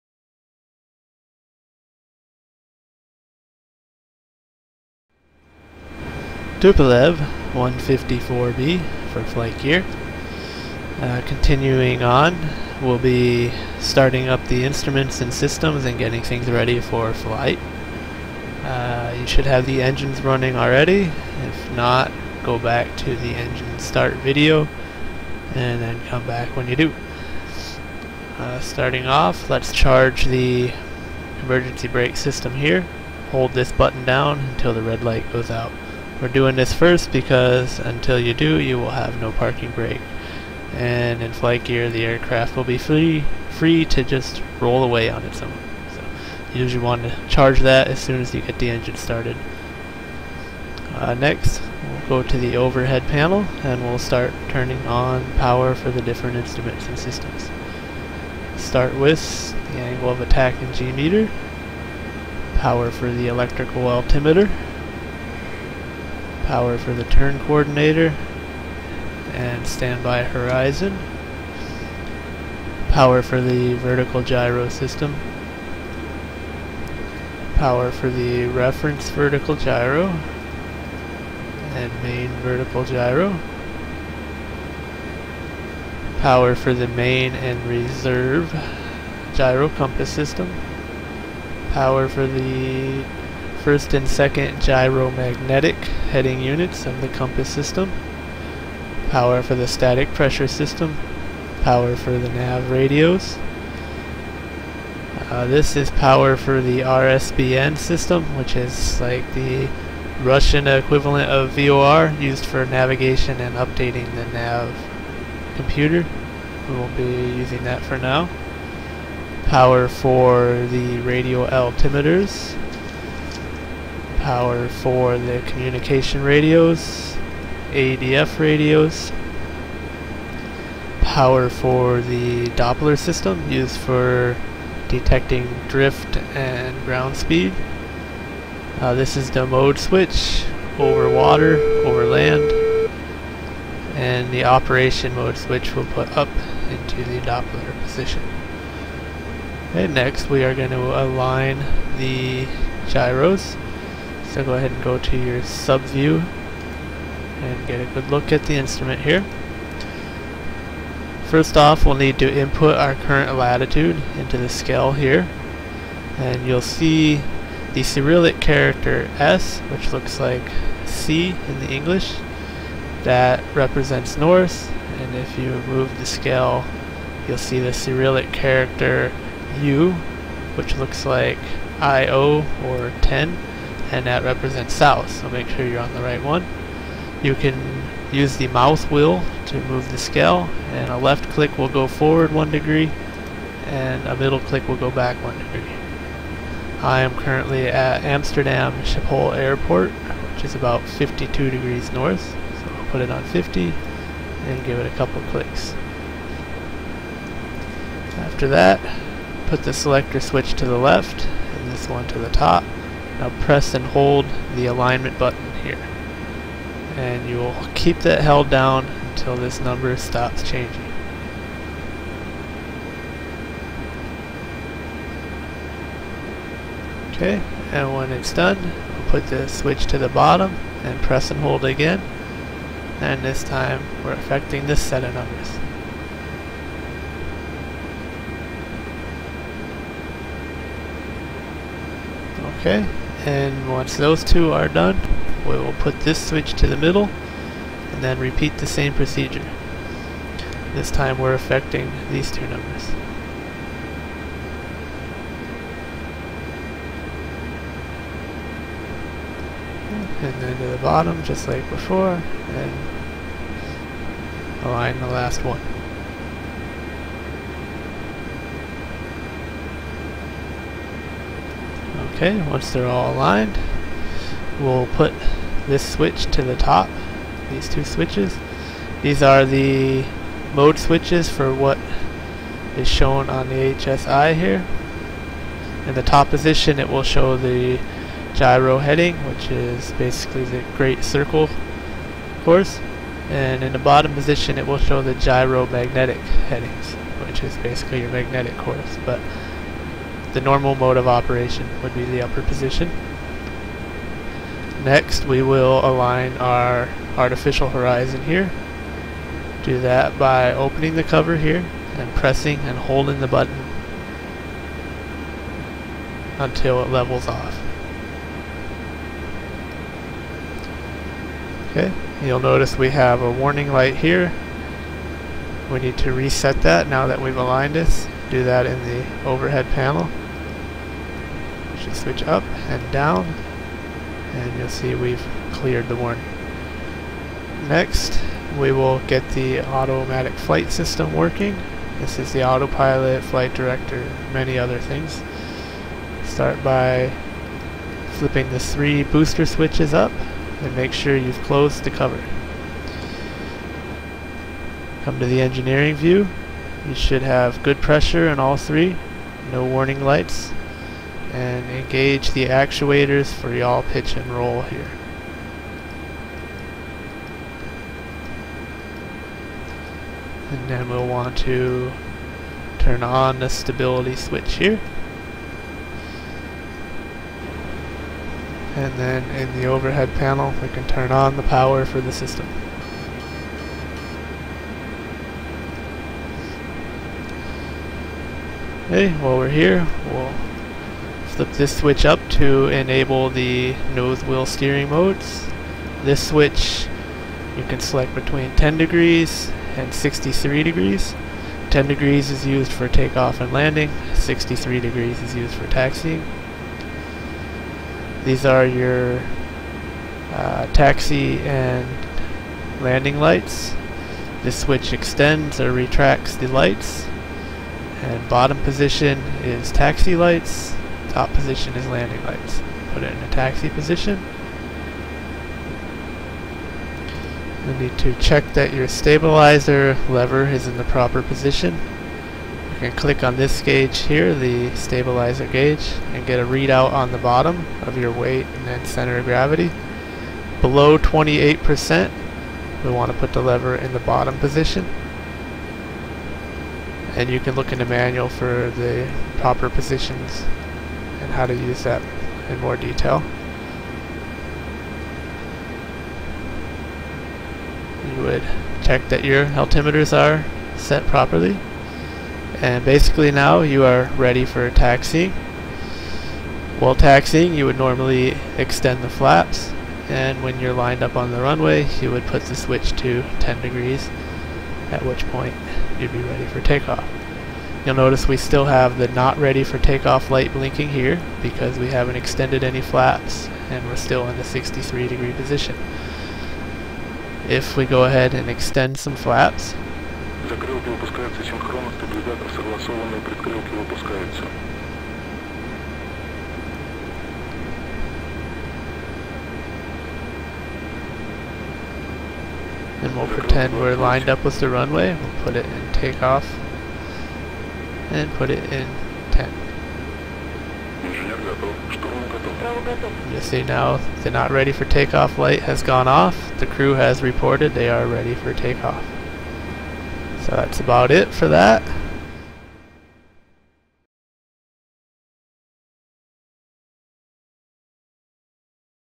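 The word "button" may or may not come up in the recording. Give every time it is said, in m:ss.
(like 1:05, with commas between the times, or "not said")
0:33, 3:35, 5:13.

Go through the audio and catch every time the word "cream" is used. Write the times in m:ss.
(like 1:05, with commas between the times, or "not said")
not said.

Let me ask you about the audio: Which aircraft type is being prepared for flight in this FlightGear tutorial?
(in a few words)
Tupolev 154B.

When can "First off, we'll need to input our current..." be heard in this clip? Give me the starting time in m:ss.
2:41.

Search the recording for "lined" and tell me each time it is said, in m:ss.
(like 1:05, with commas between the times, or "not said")
7:50, 8:23.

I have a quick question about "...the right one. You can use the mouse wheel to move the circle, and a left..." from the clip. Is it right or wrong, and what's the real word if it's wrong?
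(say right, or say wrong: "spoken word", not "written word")
wrong: "scale", not "circle".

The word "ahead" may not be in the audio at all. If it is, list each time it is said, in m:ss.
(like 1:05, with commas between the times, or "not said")
2:34, 8:08.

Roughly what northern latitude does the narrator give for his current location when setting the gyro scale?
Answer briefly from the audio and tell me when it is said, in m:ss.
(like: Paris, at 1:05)
52 degrees, at 3:20.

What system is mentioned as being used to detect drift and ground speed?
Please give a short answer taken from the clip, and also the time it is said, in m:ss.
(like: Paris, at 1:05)
Doppler system, at 2:12.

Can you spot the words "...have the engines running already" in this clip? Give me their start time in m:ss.
0:19.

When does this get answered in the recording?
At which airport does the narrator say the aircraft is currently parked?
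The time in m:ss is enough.
3:18.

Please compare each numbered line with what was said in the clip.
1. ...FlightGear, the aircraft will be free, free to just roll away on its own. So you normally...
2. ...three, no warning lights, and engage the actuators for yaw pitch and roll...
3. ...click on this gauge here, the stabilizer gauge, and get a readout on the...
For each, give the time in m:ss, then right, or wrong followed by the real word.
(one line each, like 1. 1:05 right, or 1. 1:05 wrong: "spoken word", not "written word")
1. 0:41 wrong: "usually", not "normally"
2. 5:58 right
3. 7:12 right.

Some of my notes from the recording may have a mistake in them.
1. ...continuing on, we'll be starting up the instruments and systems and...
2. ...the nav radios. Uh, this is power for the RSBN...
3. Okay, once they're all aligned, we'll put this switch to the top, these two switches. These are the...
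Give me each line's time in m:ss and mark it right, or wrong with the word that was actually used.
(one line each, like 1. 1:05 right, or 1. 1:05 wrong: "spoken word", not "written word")
1. 0:11 right
2. 1:42 right
3. 4:32 right.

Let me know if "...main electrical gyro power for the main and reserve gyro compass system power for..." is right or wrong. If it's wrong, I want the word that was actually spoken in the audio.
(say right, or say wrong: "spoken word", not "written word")
wrong: "vertical", not "electrical".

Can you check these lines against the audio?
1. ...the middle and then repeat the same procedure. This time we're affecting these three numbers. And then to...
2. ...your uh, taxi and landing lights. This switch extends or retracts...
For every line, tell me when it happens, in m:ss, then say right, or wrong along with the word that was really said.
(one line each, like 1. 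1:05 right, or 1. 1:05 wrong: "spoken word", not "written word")
1. 4:06 wrong: "two", not "three"
2. 6:48 right.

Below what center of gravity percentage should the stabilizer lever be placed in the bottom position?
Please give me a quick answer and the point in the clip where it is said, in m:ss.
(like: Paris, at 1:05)
28%, at 7:20.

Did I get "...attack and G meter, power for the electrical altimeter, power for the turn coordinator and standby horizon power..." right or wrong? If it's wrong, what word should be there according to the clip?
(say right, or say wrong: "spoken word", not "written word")
right.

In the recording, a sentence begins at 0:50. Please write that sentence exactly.
Uh, next, we'll go to the overhead panel and we'll start turning on power for the different instruments and systems.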